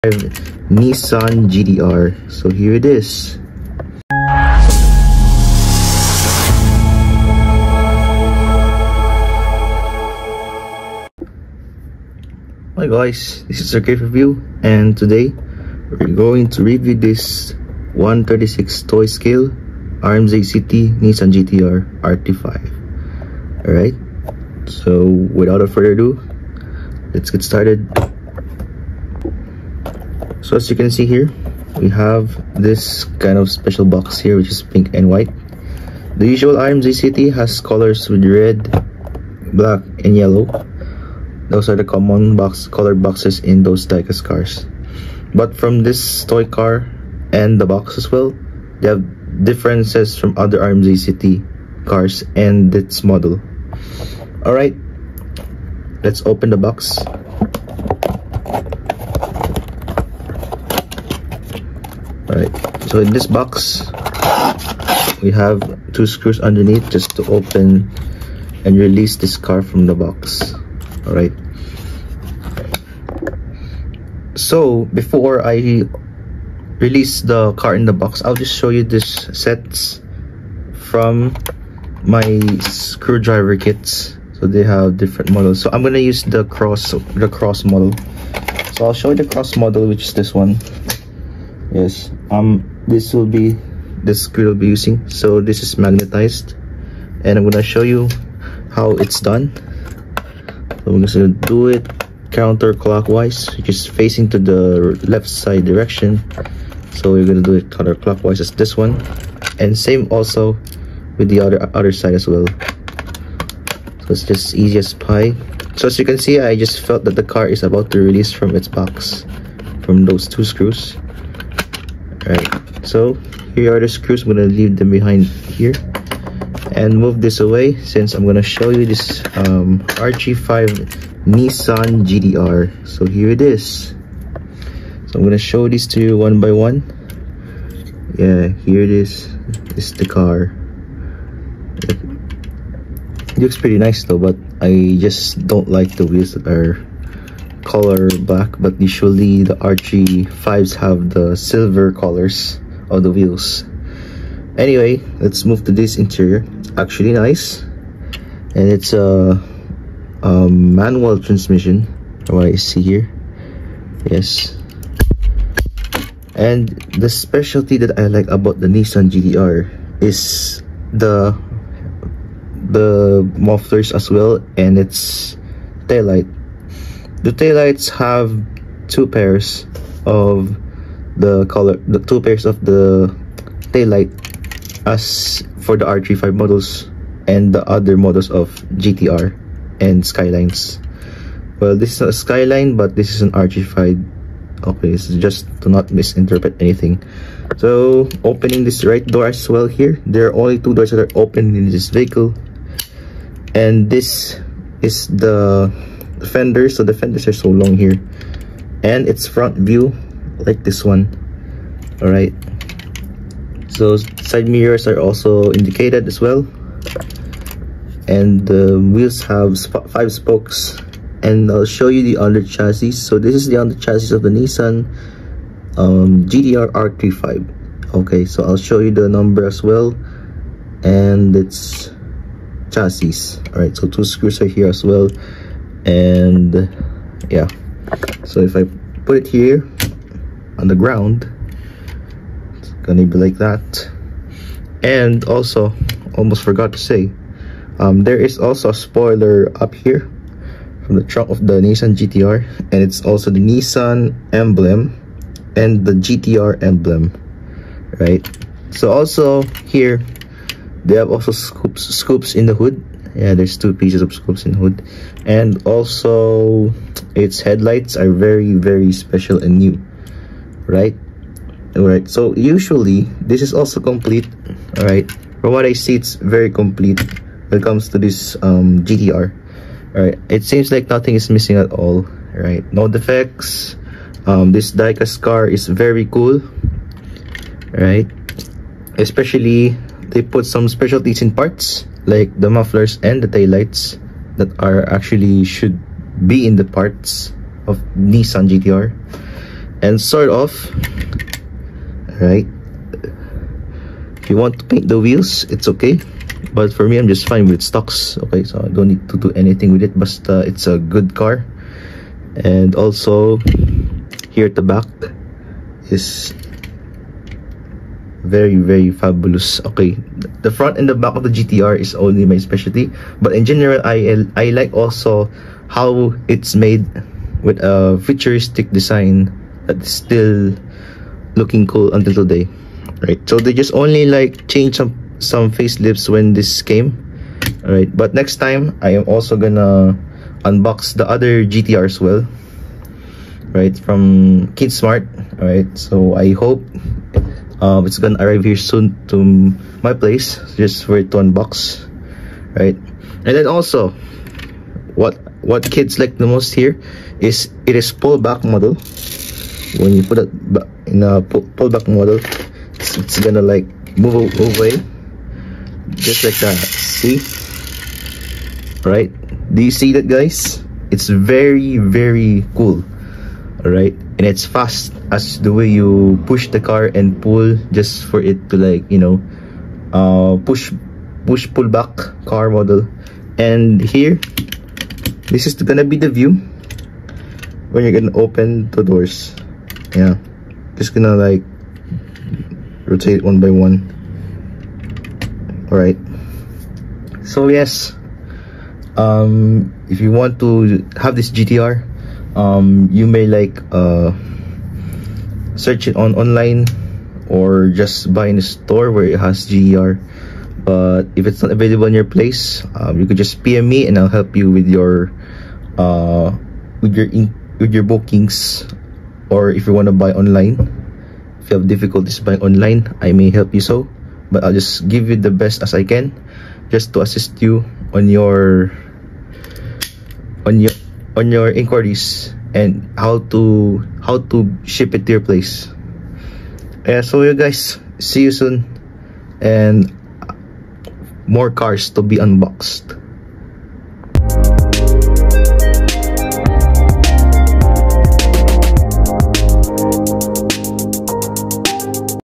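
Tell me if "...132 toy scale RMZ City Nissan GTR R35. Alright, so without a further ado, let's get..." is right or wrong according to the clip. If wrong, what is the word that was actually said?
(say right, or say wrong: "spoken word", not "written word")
wrong: "136", not "132".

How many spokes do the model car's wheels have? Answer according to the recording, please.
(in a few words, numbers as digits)
5.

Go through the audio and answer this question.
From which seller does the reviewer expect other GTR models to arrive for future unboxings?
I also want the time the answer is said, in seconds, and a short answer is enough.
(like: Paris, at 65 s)
Kidsmart, at 344 s.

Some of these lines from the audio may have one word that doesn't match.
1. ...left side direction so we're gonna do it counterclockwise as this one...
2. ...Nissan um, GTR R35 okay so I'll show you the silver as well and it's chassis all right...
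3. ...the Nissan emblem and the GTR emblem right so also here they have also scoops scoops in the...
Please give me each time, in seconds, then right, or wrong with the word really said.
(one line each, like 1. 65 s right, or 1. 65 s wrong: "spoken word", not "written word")
1. 105 s right
2. 224 s wrong: "number", not "silver"
3. 253 s right.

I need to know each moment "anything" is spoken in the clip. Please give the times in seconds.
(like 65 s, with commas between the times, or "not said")
196 s, 309 s.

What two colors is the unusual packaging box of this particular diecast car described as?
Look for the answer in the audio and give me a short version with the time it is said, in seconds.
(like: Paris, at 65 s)
pink and white, at 34 s.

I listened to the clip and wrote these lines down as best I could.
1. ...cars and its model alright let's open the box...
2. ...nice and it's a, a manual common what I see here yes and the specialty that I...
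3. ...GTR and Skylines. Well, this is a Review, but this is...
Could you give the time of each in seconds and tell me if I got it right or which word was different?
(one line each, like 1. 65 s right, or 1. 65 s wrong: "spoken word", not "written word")
1. 51 s right
2. 157 s wrong: "transmission", not "common"
3. 188 s wrong: "Skyline", not "Review".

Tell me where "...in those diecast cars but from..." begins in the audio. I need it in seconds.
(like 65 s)
43 s.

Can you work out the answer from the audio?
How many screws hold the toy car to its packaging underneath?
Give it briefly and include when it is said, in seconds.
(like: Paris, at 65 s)
2, at 65 s.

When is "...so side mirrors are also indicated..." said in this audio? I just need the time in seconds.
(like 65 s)
213 s.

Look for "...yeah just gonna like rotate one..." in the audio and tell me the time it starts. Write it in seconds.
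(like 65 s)
389 s.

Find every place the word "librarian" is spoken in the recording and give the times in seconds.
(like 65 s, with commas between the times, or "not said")
not said.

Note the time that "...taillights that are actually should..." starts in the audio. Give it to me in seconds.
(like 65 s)
293 s.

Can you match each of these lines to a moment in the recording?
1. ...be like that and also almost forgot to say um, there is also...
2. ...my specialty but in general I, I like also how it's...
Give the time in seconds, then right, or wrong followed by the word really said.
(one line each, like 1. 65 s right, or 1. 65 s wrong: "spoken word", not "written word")
1. 243 s right
2. 322 s right.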